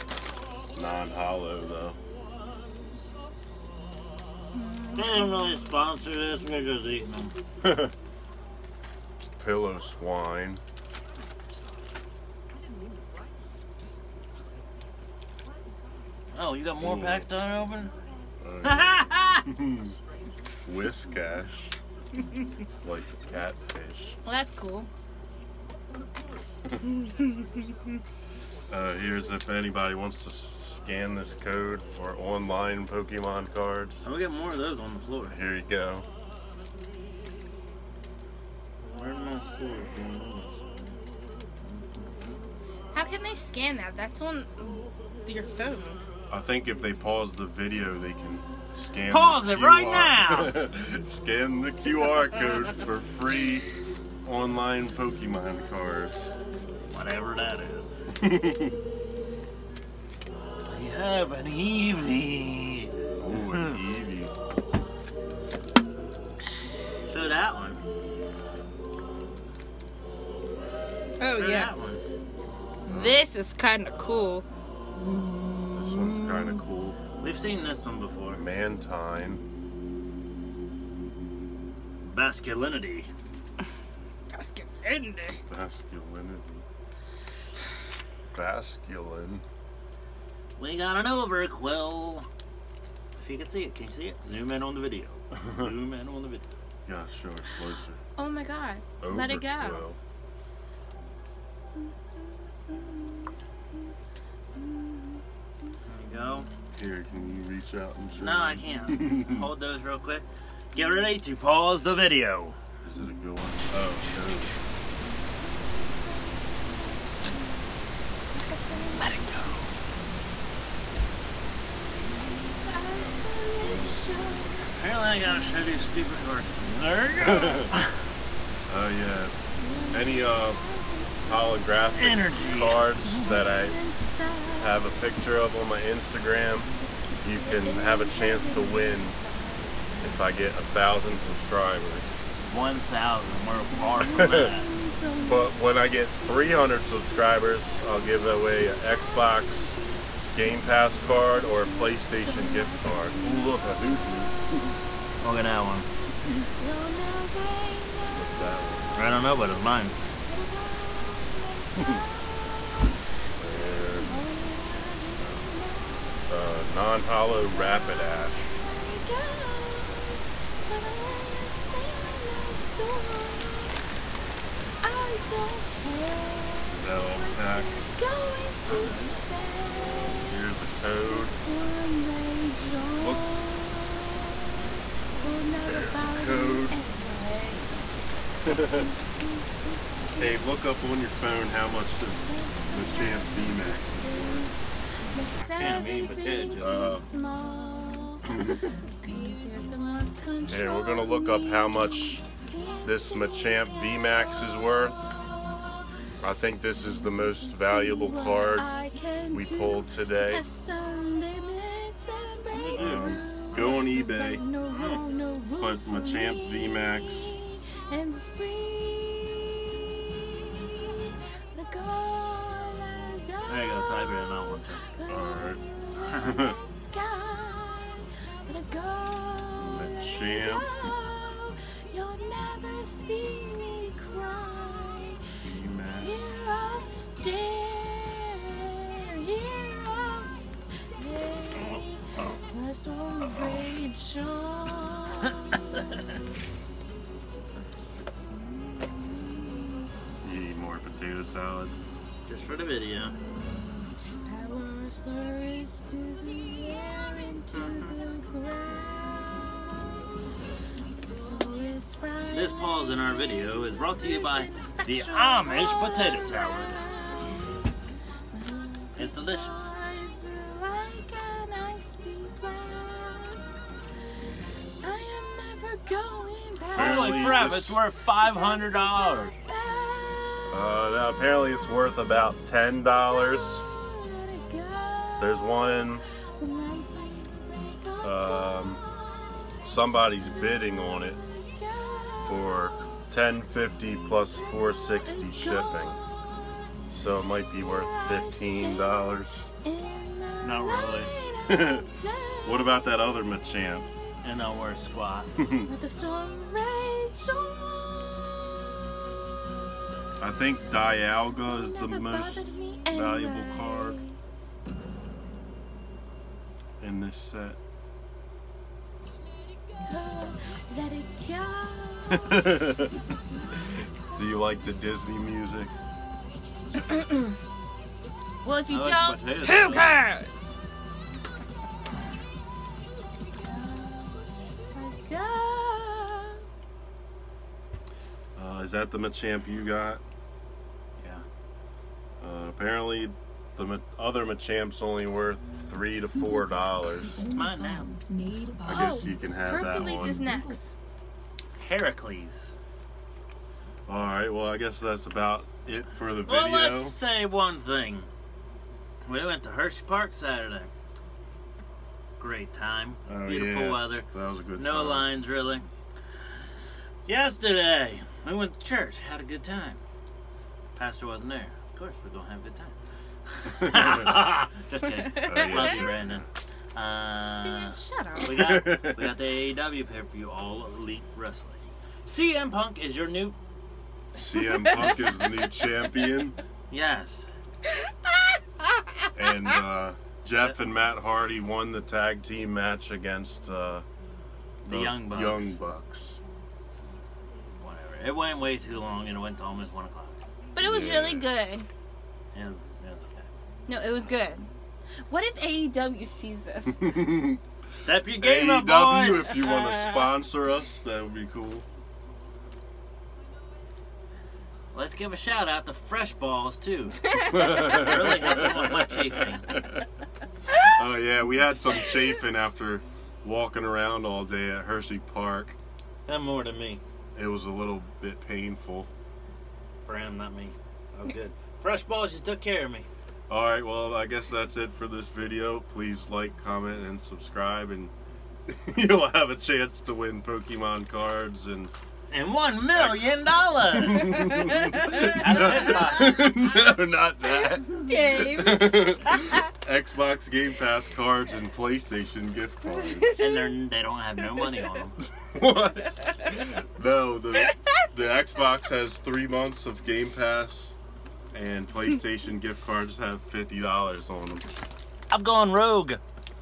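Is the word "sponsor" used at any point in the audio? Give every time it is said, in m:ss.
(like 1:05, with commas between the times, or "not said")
0:05, 6:49.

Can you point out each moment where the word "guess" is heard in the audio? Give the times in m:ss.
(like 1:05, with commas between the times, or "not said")
5:48, 5:54, 7:14.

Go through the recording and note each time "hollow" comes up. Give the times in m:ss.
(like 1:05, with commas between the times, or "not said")
0:01, 2:46.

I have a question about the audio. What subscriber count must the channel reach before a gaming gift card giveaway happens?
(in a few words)
300.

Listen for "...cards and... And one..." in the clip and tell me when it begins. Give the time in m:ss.
7:20.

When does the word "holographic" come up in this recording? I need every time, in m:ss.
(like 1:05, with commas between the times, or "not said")
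2:11.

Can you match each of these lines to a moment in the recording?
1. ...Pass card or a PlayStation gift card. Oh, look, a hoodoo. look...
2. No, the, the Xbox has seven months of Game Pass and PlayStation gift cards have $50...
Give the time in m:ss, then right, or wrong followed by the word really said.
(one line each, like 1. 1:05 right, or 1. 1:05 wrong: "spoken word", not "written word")
1. 2:30 right
2. 7:36 wrong: "three", not "seven".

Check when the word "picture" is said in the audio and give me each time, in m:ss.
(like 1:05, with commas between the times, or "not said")
2:14.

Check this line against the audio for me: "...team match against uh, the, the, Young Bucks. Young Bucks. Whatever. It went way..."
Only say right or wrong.
right.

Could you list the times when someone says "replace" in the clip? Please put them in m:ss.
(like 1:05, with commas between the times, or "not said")
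not said.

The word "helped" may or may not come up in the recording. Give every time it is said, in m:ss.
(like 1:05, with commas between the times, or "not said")
6:58.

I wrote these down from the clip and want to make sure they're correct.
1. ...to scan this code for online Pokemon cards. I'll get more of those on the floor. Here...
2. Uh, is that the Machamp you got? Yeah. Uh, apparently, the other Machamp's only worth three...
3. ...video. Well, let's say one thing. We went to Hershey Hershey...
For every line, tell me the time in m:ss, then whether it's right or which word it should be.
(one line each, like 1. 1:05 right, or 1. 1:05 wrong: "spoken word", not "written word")
1. 0:30 right
2. 5:38 right
3. 5:56 wrong: "Park", not "Hershey".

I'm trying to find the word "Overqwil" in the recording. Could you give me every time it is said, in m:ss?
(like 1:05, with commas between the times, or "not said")
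1:31, 1:39.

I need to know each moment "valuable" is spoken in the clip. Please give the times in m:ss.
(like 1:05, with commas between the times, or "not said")
3:27, 5:12.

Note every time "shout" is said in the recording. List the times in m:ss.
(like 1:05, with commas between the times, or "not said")
6:55.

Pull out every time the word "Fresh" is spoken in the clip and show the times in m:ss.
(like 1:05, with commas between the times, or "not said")
6:55, 7:11.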